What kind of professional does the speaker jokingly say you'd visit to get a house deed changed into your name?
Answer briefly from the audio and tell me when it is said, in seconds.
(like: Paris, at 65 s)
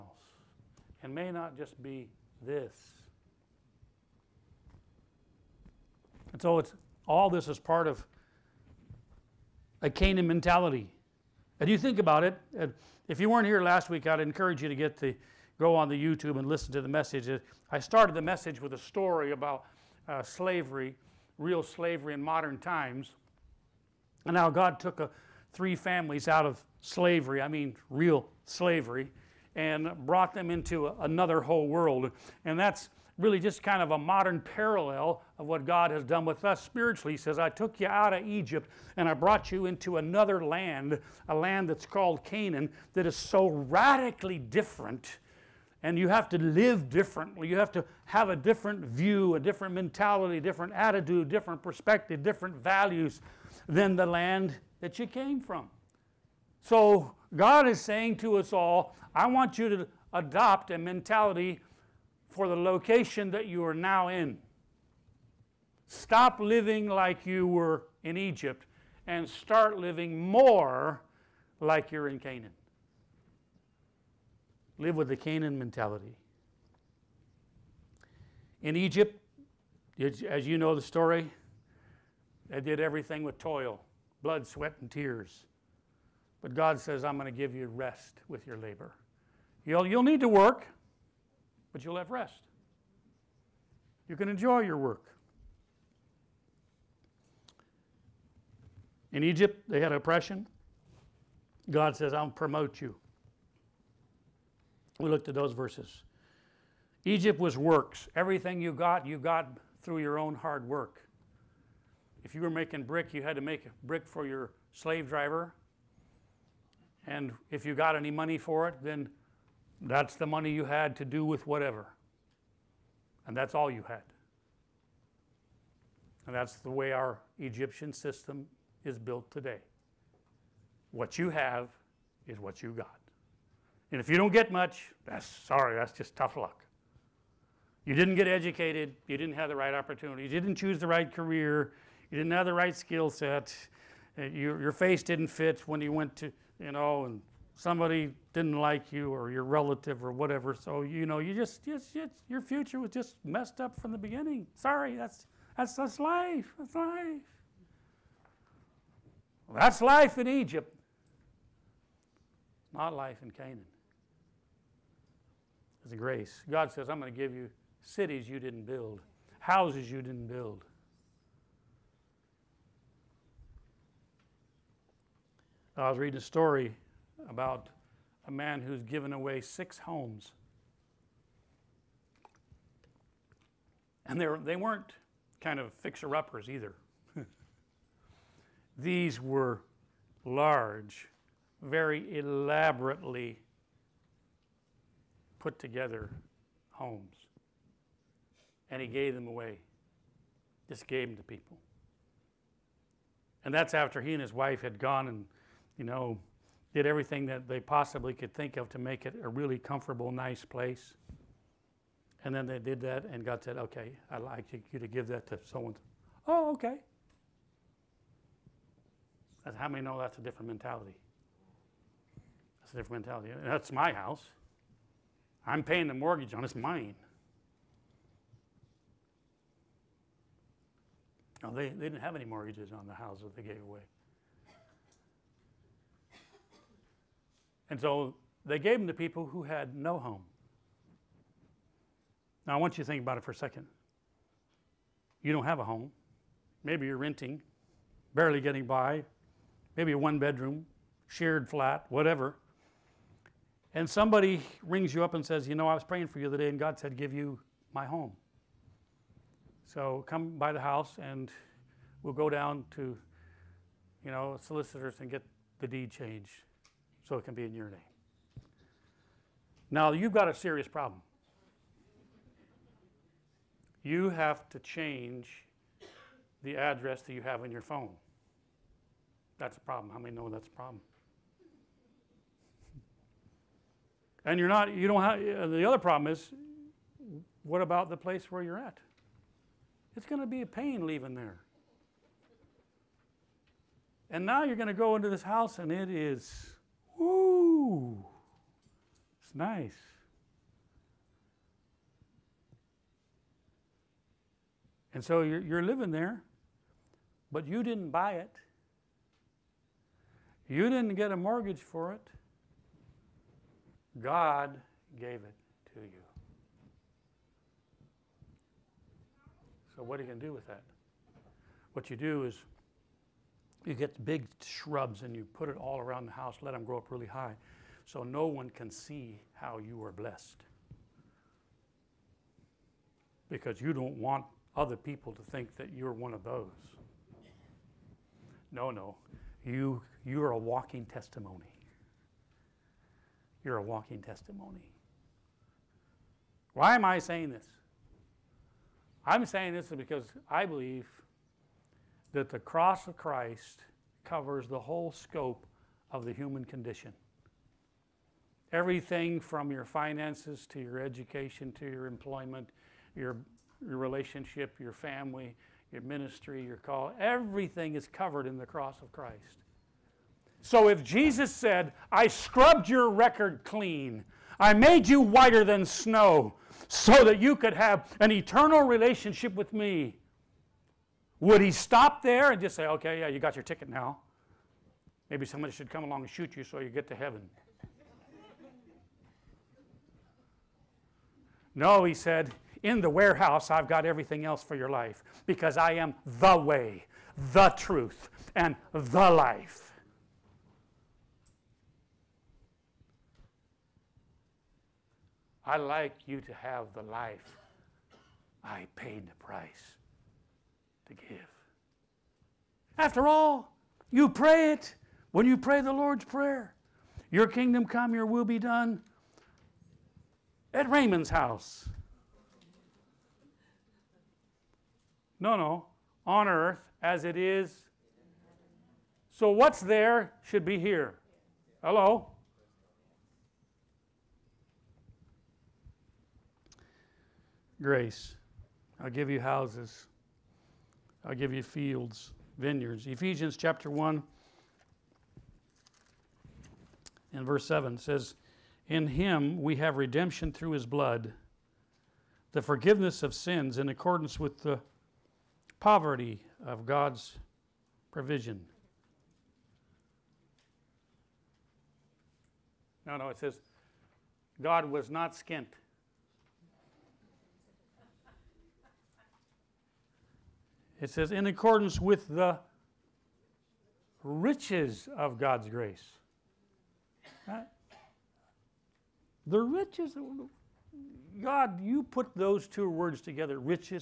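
Solicitors, at 264 s.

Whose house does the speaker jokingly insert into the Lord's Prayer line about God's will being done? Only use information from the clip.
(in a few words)
Raymond's.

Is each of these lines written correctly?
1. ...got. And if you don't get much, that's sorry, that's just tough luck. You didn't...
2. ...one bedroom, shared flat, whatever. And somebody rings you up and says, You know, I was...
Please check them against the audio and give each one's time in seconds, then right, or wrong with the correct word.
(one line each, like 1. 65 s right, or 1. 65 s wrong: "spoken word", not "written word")
1. 132 s right
2. 249 s right.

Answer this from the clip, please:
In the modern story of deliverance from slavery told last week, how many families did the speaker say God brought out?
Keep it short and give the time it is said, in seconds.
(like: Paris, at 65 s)
3, at 25 s.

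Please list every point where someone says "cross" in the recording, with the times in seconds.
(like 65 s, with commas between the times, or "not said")
352 s, 368 s.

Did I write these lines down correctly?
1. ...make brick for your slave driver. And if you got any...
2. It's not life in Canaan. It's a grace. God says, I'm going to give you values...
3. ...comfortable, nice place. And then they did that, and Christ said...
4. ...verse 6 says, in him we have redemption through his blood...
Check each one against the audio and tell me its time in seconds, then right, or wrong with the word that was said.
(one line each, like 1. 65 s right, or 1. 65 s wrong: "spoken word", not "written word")
1. 113 s right
2. 162 s wrong: "cities", not "values"
3. 209 s wrong: "God", not "Christ"
4. 447 s wrong: "7", not "6".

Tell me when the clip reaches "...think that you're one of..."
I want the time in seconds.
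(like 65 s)
335 s.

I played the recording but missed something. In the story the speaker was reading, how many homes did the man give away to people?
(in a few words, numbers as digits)
6.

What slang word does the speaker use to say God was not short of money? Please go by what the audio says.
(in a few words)
Skint.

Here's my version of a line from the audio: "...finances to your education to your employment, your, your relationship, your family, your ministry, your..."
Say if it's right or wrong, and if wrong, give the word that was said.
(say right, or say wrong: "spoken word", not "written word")
right.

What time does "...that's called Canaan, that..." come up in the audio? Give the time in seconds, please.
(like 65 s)
41 s.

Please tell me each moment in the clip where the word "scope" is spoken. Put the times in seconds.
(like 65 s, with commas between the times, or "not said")
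354 s.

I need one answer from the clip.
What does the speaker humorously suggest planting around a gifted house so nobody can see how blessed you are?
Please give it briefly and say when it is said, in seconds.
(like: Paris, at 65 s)
Big shrubs, at 324 s.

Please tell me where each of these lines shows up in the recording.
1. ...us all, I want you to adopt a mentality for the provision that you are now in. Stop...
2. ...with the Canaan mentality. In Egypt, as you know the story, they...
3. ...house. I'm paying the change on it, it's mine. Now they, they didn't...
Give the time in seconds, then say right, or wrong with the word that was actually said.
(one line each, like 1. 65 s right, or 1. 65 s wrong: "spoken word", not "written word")
1. 58 s wrong: "location", not "provision"
2. 74 s right
3. 223 s wrong: "mortgage", not "change".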